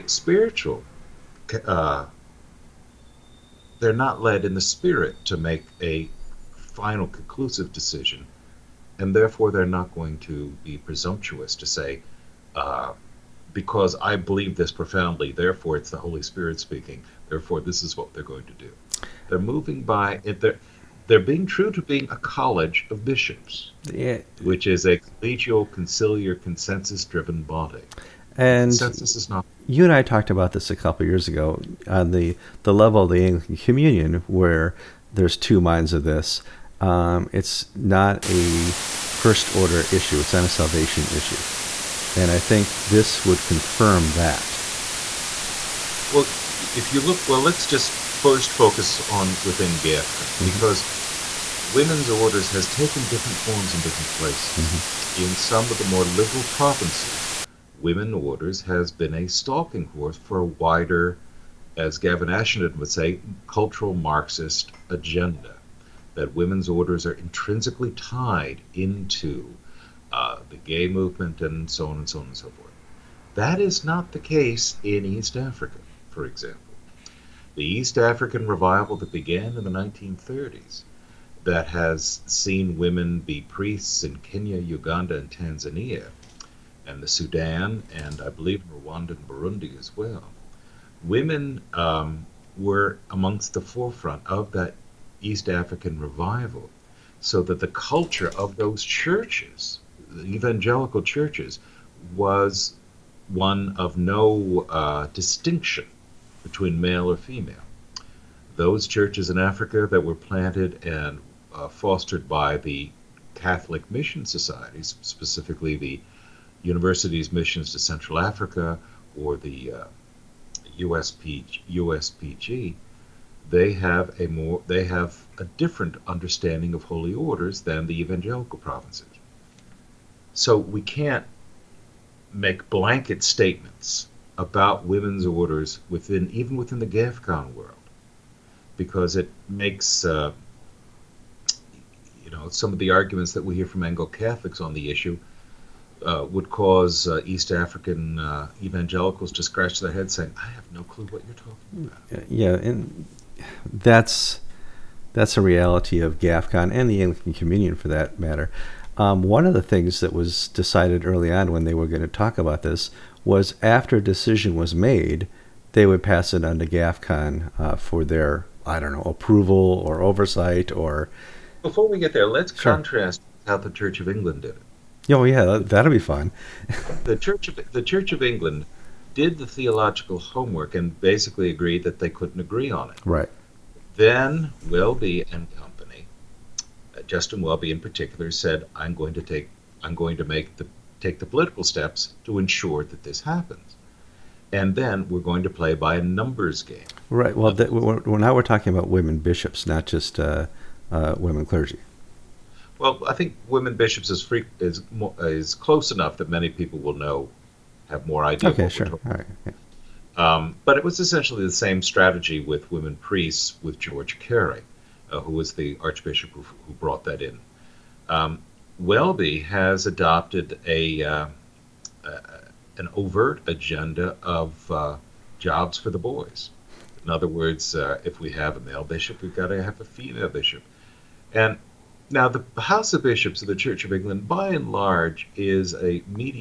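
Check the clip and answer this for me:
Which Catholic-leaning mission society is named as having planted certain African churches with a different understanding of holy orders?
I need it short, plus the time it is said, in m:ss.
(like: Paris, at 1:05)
Universities' Missions to Central Africa, at 1:56.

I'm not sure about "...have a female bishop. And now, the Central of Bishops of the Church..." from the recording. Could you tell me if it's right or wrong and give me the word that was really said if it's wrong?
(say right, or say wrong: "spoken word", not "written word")
wrong: "House", not "Central".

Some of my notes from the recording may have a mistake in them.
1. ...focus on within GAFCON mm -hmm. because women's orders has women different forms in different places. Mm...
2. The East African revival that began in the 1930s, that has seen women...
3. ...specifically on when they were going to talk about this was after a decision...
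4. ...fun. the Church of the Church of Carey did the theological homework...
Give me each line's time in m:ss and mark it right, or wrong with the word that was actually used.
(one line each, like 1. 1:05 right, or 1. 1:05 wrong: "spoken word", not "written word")
1. 0:48 wrong: "taken", not "women"
2. 1:17 right
3. 2:41 wrong: "early", not "specifically"
4. 2:55 wrong: "England", not "Carey".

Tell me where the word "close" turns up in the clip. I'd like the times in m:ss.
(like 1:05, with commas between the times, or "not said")
3:25.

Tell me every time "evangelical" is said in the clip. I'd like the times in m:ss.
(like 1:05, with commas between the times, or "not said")
1:40, 2:07, 2:28.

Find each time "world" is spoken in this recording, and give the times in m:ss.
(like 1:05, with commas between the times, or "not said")
2:17.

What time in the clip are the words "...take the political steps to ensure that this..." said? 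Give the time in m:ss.
3:10.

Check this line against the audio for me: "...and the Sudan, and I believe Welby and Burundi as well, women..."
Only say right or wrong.
wrong.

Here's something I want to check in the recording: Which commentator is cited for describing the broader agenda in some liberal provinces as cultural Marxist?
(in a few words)
Gavin Ashenden.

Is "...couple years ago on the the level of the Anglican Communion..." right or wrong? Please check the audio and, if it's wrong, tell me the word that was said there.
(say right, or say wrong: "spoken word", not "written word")
right.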